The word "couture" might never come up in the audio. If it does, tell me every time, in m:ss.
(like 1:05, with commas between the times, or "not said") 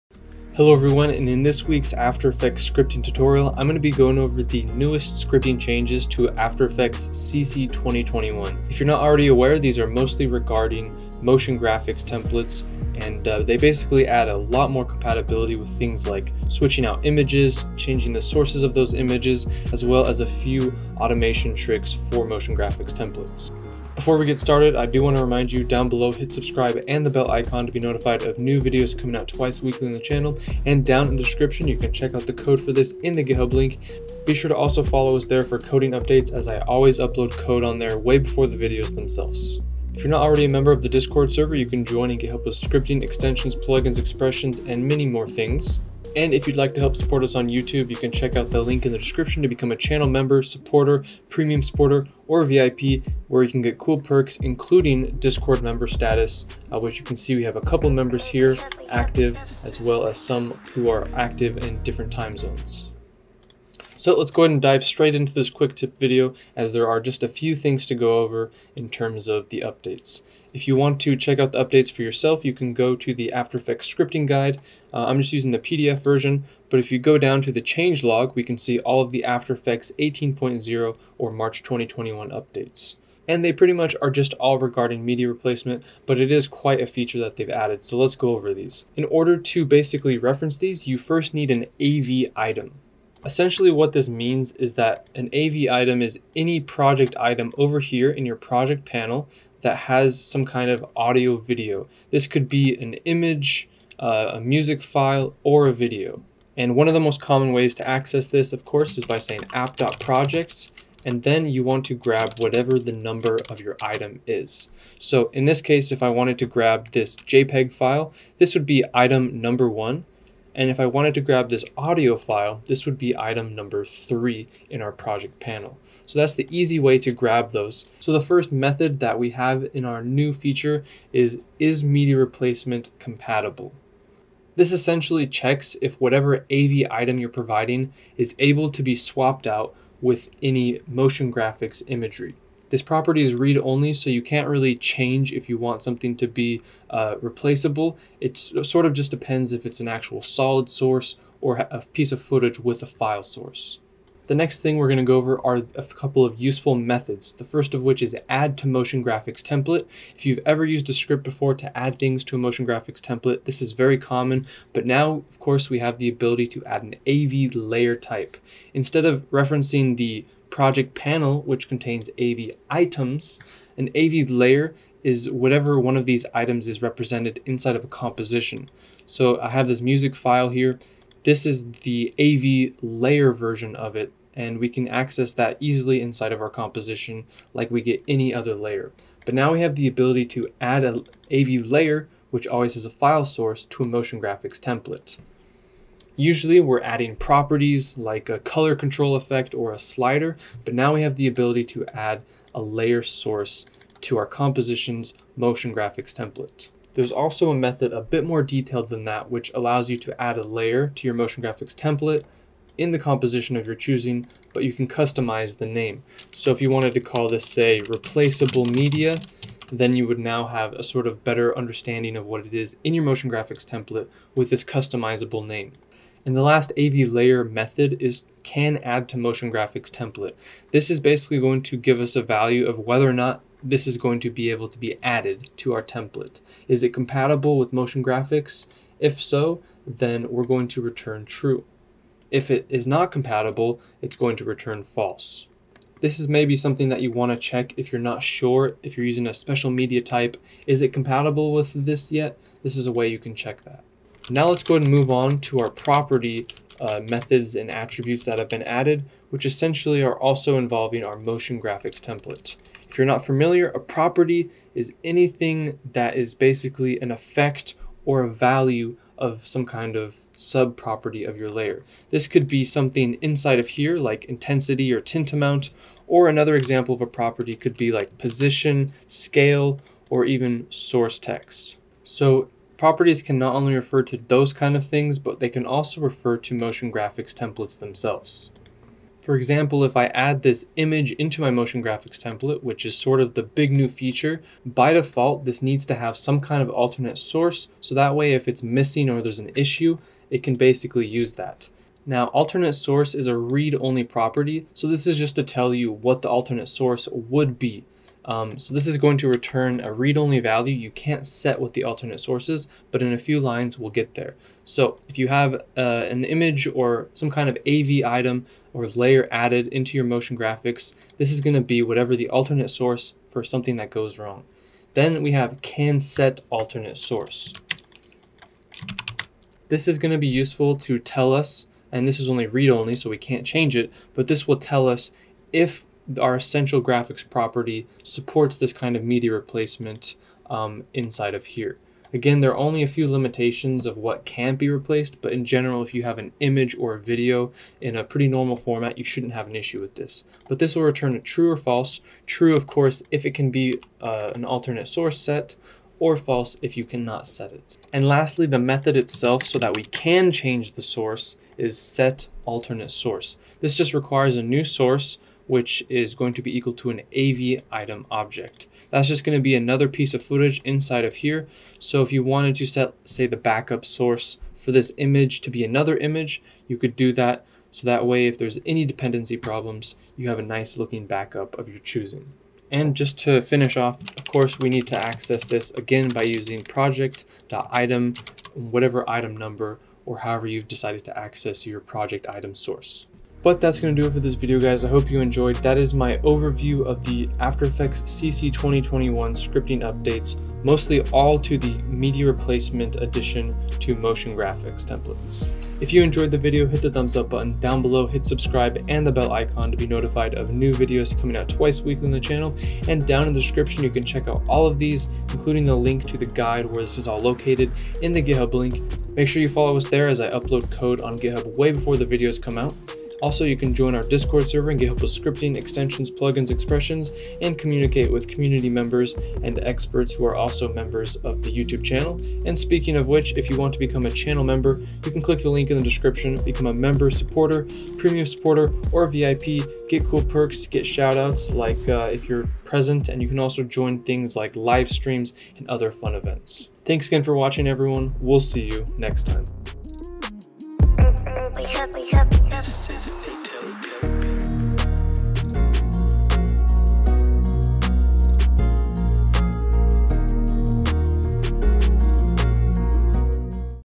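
not said.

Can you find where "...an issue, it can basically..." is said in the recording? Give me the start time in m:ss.
4:59.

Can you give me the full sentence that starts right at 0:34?
Be sure to also follow us there for coding updates as I always upload code on there way before the videos themselves.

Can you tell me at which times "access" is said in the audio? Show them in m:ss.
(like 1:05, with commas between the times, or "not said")
1:47, 3:04, 6:25, 6:31.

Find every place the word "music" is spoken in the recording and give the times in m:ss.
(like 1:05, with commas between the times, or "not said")
1:44, 2:59.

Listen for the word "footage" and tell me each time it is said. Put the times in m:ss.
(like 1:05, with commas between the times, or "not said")
2:32, 6:10.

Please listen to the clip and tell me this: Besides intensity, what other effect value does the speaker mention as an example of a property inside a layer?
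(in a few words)
tint amount.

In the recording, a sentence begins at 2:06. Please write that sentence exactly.
So that's the easy way to grab those.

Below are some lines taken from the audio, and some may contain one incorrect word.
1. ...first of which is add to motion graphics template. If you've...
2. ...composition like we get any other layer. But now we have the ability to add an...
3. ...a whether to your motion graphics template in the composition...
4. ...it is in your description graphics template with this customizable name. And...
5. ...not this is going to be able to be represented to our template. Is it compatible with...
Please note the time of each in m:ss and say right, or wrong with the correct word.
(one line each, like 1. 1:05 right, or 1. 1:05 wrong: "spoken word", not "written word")
1. 2:37 right
2. 3:06 right
3. 3:30 wrong: "layer", not "whether"
4. 3:42 wrong: "motion", not "description"
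5. 3:53 wrong: "added", not "represented".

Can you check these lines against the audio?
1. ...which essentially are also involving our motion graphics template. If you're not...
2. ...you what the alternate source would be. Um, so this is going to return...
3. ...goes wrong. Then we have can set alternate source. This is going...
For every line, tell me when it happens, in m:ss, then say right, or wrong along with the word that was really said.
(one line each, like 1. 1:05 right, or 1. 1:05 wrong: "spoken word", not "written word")
1. 4:19 right
2. 5:05 right
3. 5:23 right.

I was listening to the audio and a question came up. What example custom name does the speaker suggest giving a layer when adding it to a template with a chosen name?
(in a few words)
replaceable media.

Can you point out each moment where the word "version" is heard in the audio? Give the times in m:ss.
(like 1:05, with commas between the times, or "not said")
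1:16, 3:03.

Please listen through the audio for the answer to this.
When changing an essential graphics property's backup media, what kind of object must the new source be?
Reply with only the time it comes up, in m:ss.
6:07.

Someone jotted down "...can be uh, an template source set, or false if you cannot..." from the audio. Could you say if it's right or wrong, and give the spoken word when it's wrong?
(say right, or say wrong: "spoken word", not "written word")
wrong: "alternate", not "template".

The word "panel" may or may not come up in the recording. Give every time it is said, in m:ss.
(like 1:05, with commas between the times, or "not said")
1:38, 2:05, 2:50.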